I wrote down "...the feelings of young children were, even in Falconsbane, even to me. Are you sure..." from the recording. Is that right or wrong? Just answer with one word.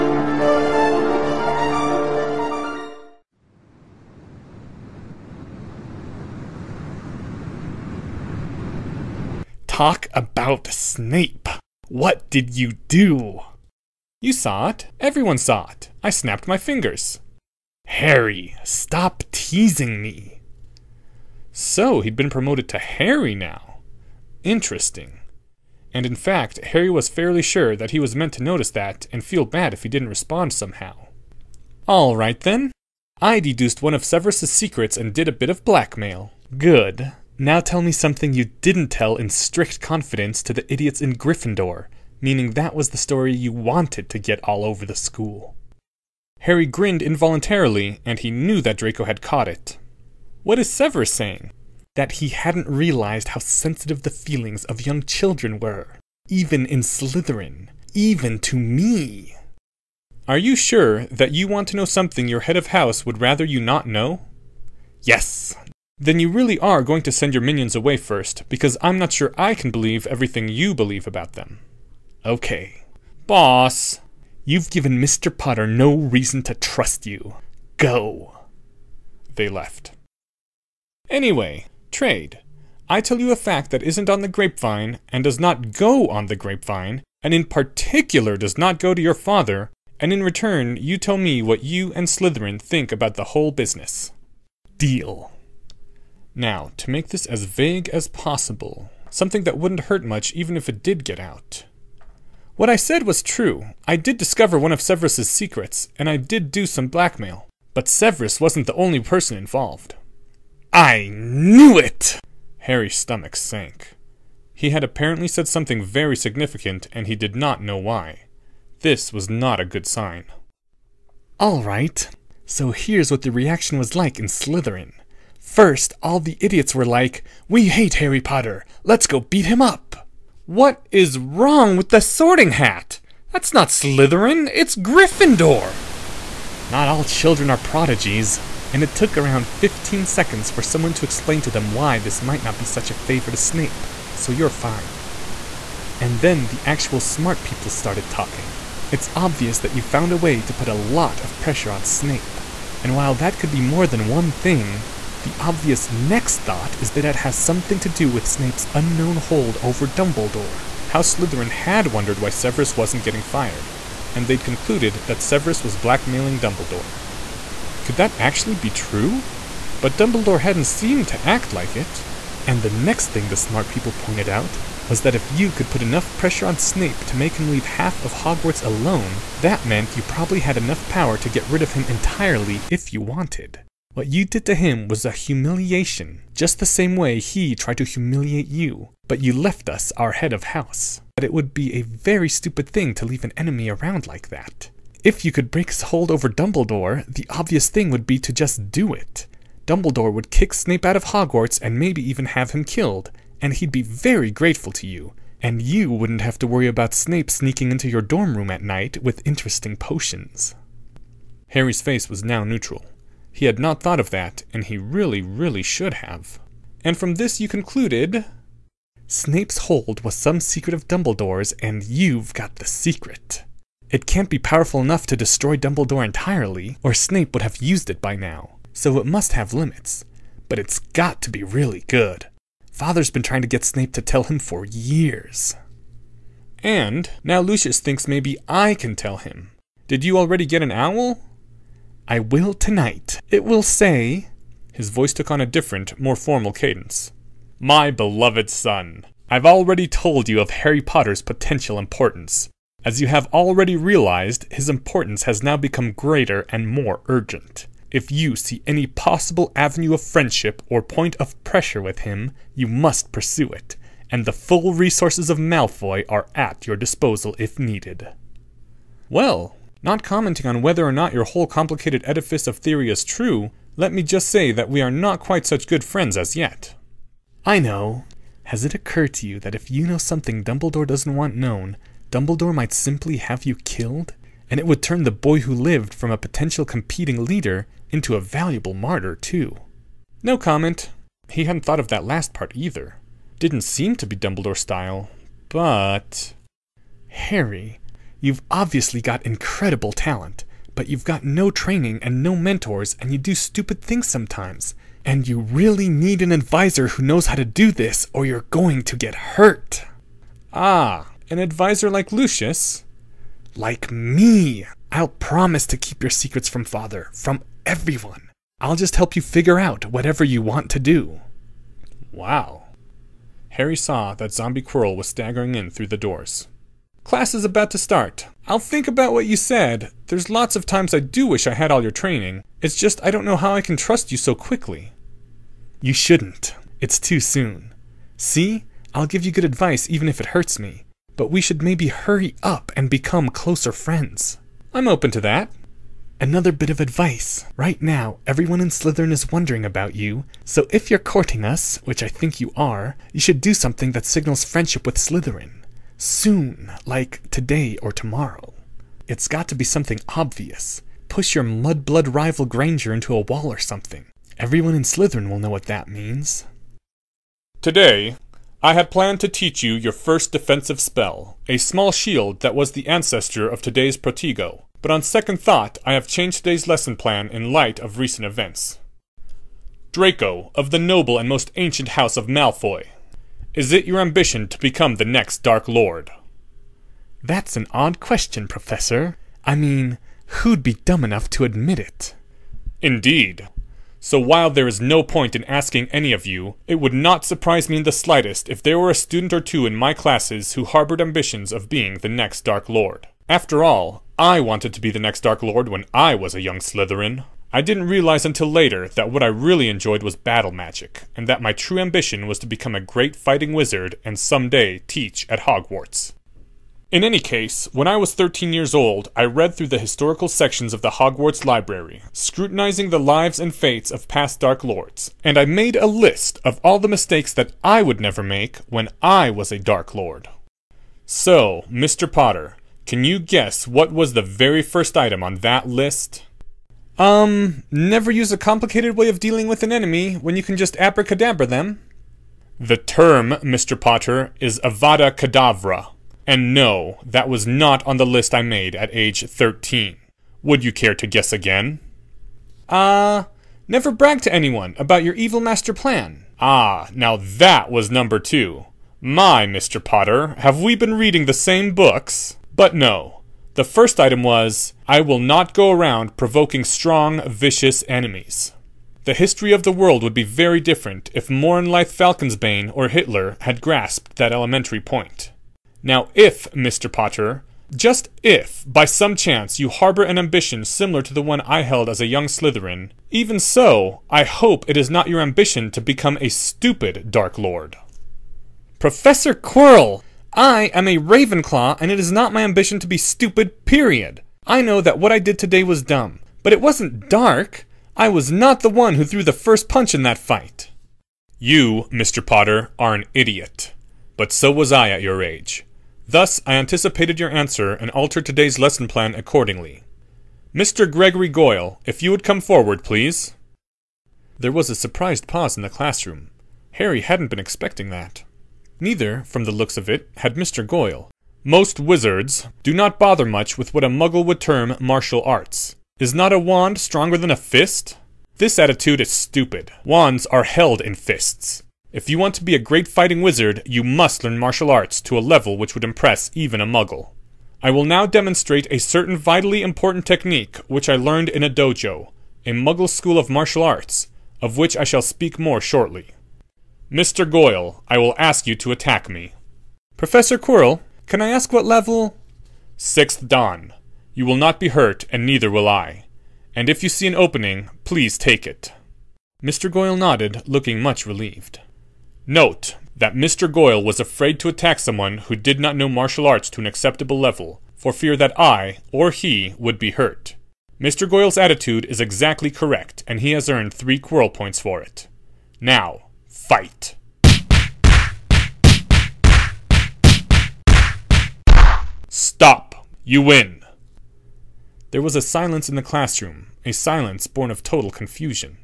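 wrong.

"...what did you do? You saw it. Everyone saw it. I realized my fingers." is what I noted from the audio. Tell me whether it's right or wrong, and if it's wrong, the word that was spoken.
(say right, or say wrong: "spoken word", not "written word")
wrong: "snapped", not "realized".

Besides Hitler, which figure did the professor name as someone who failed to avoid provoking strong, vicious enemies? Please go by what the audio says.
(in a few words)
Mornelithe Falconsbane.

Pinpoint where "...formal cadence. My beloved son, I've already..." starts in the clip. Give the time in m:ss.
4:06.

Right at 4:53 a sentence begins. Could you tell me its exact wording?
Didn't seem to be Dumbledore style, but.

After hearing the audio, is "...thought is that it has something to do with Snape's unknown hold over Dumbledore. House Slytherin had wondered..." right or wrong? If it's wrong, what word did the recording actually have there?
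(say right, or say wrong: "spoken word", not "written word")
right.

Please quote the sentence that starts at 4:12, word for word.
As you have already realized, his importance has now become greater and more urgent.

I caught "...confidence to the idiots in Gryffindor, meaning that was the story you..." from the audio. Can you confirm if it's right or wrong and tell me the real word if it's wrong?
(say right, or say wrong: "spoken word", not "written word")
right.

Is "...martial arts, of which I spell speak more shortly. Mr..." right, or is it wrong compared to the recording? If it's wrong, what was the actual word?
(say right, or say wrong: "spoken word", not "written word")
wrong: "shall", not "spell".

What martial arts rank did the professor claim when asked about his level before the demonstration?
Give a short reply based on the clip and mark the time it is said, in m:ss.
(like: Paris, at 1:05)
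Sixth dan, at 9:12.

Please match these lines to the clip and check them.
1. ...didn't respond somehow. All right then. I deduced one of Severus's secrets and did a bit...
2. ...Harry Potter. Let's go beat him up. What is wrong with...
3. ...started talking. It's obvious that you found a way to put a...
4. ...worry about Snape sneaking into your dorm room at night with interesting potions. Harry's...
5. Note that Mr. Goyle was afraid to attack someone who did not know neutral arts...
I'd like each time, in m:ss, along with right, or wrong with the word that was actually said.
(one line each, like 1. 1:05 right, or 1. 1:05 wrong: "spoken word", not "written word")
1. 0:29 right
2. 2:07 right
3. 2:27 right
4. 3:26 right
5. 9:22 wrong: "martial", not "neutral".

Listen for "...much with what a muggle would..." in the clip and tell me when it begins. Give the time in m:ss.
8:43.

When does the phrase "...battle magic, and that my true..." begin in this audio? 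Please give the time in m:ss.
6:50.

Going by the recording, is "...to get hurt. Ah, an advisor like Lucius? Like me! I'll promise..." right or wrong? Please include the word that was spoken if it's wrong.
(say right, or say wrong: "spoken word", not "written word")
right.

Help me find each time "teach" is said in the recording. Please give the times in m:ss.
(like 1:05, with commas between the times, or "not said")
6:09, 6:54.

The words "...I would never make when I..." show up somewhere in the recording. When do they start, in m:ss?
7:07.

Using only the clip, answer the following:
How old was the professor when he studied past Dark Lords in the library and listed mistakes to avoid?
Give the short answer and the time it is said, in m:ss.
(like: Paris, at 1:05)
13, at 6:58.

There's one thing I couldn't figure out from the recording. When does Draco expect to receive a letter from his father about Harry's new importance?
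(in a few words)
Tonight.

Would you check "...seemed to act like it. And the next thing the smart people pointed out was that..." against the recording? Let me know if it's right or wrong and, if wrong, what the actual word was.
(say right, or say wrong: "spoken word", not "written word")
right.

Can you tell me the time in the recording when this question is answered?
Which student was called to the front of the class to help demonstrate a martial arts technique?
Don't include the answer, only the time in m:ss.
8:30.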